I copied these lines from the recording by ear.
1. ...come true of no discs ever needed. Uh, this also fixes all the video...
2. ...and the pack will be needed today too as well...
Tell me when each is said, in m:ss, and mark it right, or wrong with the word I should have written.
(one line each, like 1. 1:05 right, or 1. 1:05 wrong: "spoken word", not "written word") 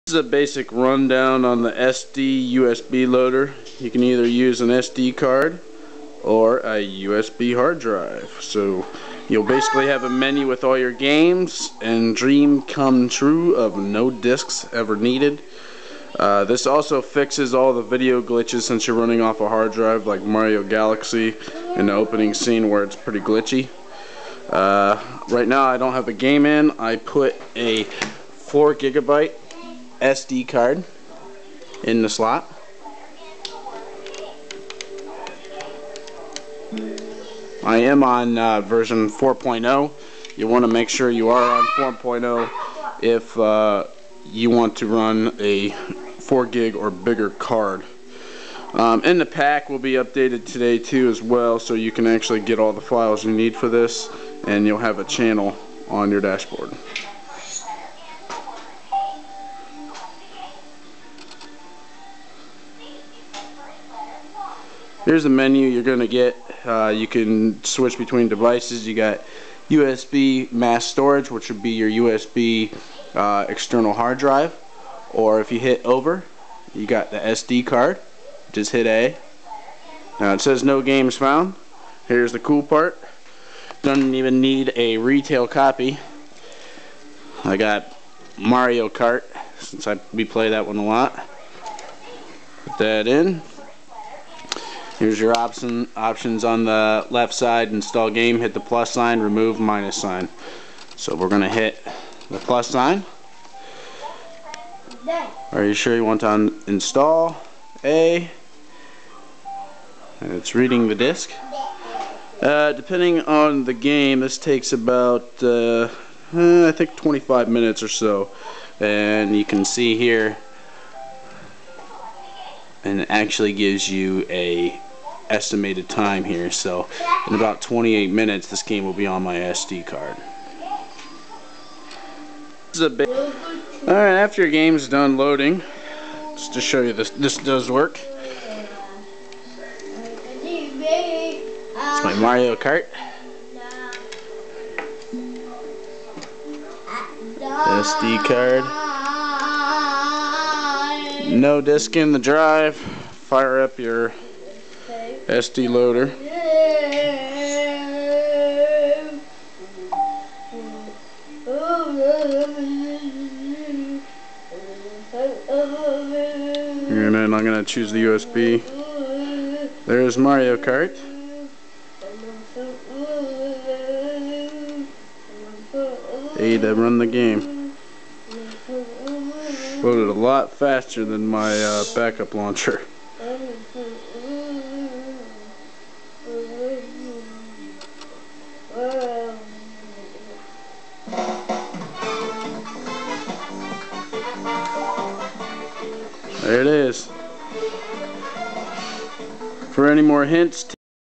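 1. 0:12 right
2. 0:49 wrong: "updated", not "needed".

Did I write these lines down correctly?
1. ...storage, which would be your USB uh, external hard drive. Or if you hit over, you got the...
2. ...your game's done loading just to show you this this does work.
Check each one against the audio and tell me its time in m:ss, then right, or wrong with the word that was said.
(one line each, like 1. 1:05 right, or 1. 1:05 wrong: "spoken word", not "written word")
1. 1:10 right
2. 2:14 right.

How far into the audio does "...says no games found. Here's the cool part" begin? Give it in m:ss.
1:20.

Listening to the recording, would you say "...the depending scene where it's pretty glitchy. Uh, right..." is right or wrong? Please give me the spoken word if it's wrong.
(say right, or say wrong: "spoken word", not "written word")
wrong: "opening", not "depending".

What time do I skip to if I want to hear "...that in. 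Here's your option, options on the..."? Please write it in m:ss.
1:32.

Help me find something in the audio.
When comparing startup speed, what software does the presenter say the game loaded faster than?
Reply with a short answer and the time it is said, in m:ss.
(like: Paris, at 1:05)
backup launcher, at 3:01.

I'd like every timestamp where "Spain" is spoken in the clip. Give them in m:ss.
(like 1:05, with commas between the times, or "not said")
not said.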